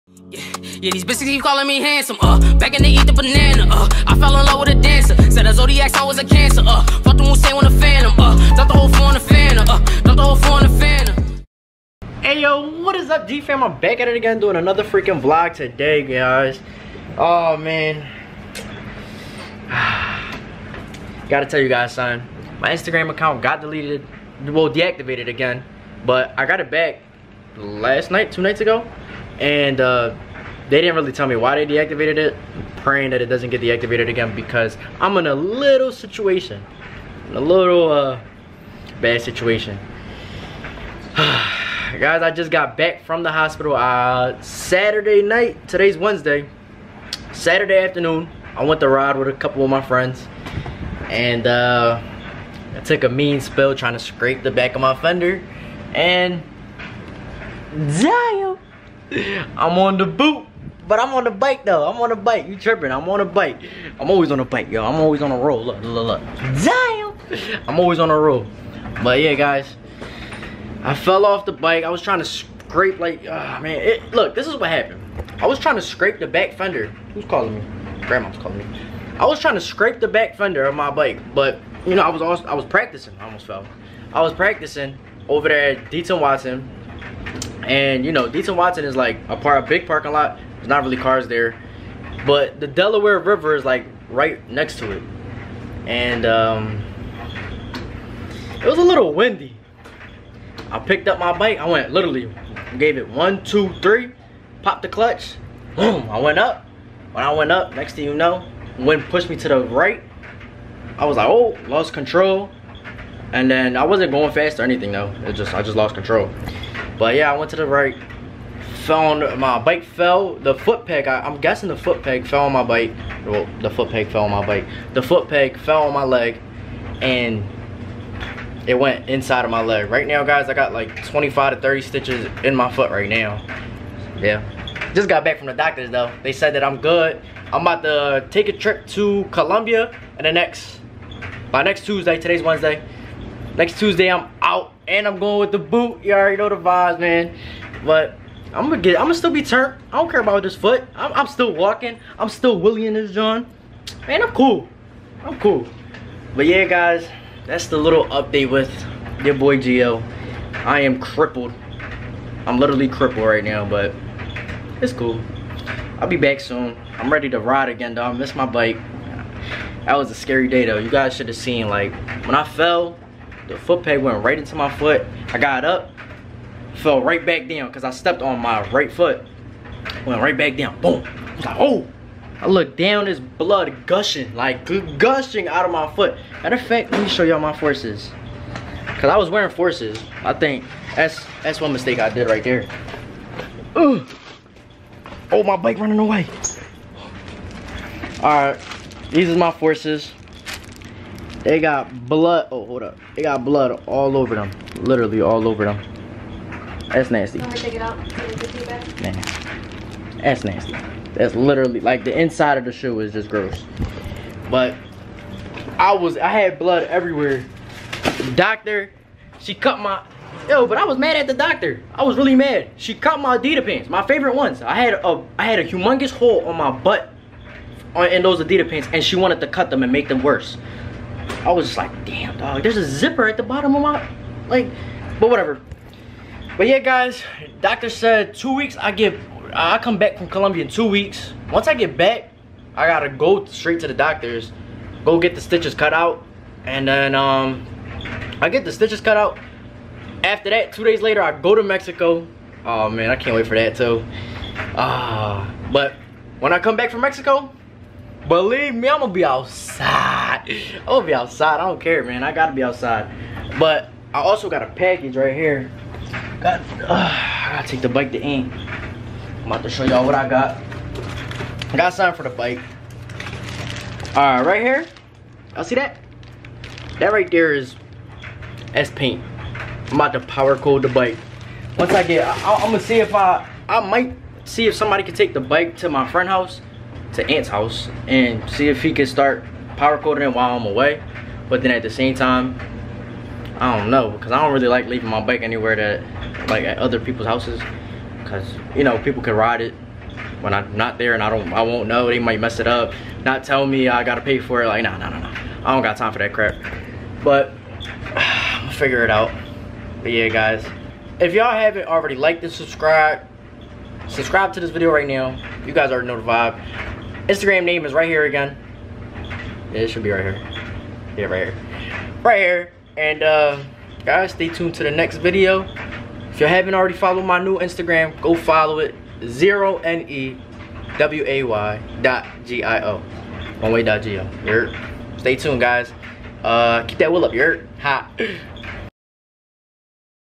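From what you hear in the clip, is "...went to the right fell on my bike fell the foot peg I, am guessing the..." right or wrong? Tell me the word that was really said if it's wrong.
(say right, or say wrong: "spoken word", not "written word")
right.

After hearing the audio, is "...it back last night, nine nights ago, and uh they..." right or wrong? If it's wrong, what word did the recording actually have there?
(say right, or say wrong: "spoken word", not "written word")
wrong: "two", not "nine".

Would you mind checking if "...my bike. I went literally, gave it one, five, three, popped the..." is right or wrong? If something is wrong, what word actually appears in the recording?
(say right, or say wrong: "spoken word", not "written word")
wrong: "two", not "five".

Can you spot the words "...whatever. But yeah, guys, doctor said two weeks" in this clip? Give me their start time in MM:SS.
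03:55.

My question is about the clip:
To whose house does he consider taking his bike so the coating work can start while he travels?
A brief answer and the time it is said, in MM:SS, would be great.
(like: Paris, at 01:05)
Ant, at 04:47.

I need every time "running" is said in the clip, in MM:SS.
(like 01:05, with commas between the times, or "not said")
03:15.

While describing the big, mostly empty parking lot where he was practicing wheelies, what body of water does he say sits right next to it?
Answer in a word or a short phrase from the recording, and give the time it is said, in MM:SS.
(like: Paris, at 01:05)
Delaware River, at 01:32.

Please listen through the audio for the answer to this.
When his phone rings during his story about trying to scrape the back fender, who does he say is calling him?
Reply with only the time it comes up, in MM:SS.
01:18.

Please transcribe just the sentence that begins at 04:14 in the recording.
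Ah, uh, but when I come back from Mexico, believe me, I'm gonna be outside.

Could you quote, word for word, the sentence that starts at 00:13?
I'm back at it again doing another freaking vlog today, guys.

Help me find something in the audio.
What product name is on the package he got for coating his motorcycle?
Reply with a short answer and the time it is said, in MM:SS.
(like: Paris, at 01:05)
S-Paint, at 04:38.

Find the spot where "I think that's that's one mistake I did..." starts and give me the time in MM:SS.
03:10.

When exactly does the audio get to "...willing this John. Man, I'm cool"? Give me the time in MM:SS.
02:32.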